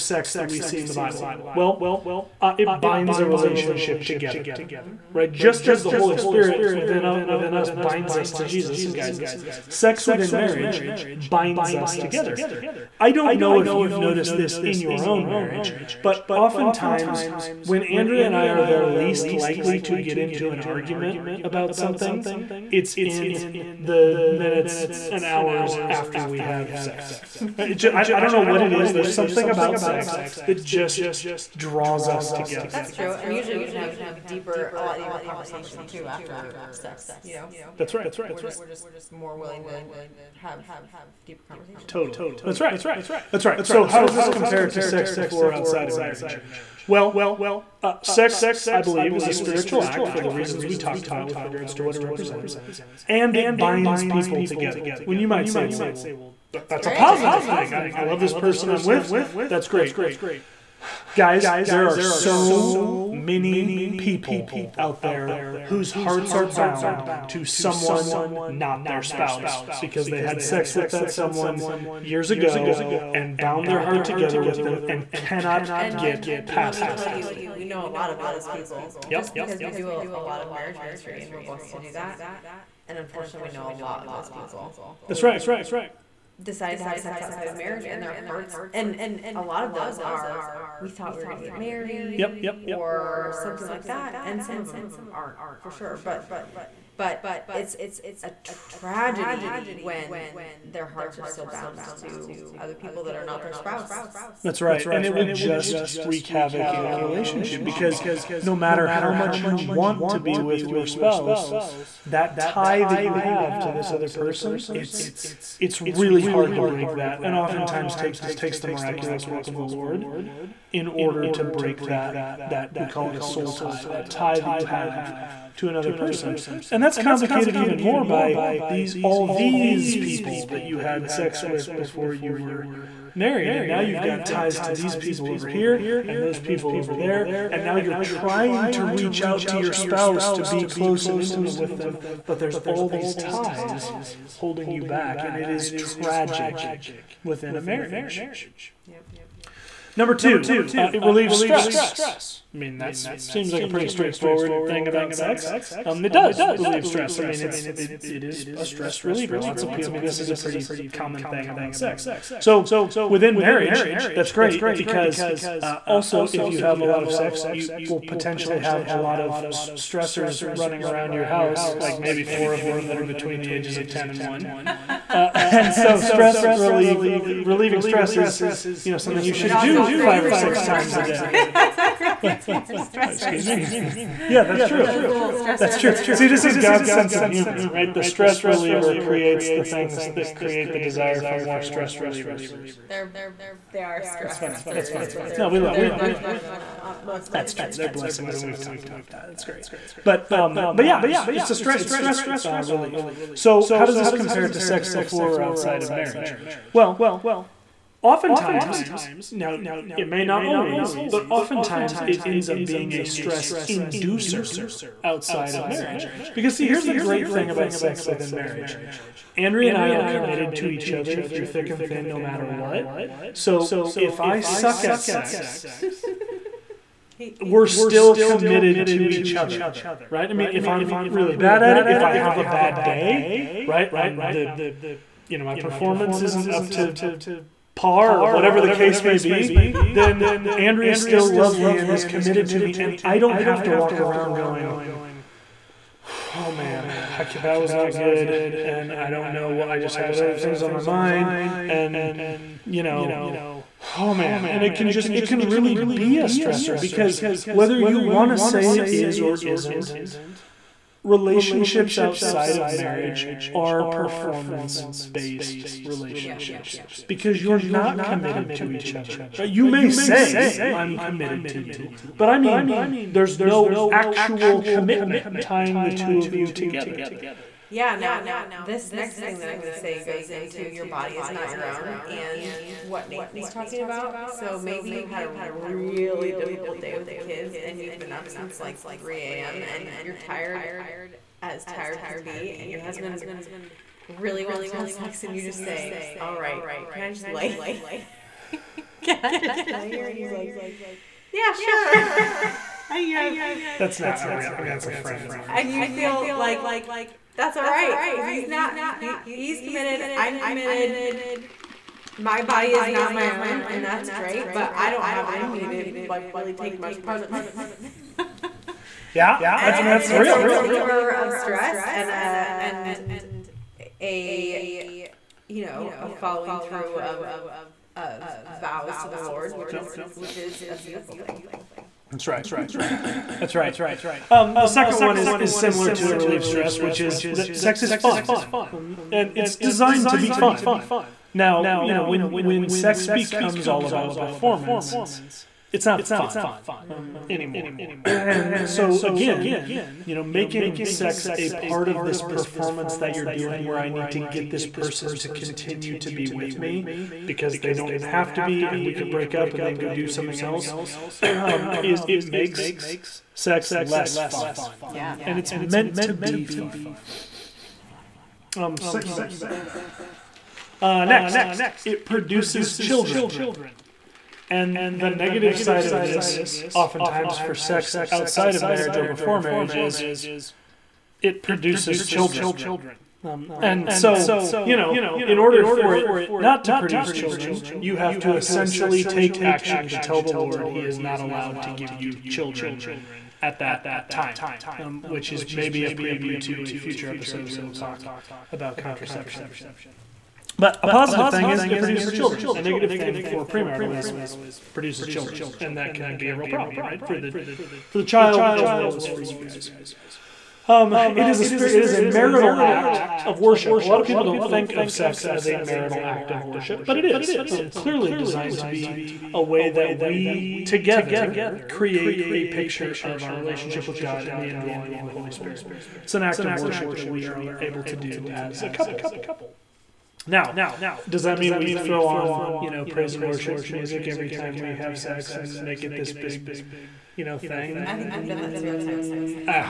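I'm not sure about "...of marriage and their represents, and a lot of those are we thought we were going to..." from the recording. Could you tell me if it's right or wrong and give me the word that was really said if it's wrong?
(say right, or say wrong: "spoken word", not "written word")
wrong: "hearts", not "represents".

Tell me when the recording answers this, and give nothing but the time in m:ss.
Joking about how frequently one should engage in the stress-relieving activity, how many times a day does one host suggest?
2:59.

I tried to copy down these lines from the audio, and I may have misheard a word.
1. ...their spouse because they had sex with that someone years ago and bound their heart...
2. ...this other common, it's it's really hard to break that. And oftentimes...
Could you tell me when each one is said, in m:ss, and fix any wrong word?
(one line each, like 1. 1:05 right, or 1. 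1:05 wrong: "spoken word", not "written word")
1. 1:08 right
2. 1:53 wrong: "person", not "common".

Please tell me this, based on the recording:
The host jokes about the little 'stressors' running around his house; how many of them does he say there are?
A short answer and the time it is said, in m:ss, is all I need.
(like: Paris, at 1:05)
4, at 2:52.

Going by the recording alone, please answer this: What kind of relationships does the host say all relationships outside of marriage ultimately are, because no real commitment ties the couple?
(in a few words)
performance based.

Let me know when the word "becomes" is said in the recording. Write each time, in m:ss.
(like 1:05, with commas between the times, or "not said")
5:43.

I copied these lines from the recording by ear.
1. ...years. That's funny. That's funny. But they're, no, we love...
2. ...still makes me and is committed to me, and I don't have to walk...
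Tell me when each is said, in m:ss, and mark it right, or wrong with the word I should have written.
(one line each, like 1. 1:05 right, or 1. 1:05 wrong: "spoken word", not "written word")
1. 3:13 wrong: "stressors", not "years"
2. 4:00 wrong: "loves", not "makes".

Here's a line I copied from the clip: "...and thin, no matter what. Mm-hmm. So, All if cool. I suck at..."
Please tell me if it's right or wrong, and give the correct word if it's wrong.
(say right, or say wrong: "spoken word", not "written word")
wrong: "Pretty", not "All".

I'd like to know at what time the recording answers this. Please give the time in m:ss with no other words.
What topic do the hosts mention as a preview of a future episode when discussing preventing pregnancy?
6:38.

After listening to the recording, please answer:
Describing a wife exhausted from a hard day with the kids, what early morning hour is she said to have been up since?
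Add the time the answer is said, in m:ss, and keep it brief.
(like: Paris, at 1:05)
3 a.m., at 4:48.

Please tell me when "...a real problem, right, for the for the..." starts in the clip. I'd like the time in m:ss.
6:46.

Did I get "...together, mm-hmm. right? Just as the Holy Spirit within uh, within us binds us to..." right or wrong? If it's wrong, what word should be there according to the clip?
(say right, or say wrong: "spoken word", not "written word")
right.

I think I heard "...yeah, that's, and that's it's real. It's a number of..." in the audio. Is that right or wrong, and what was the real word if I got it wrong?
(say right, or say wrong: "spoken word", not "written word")
wrong: "reliever", not "number".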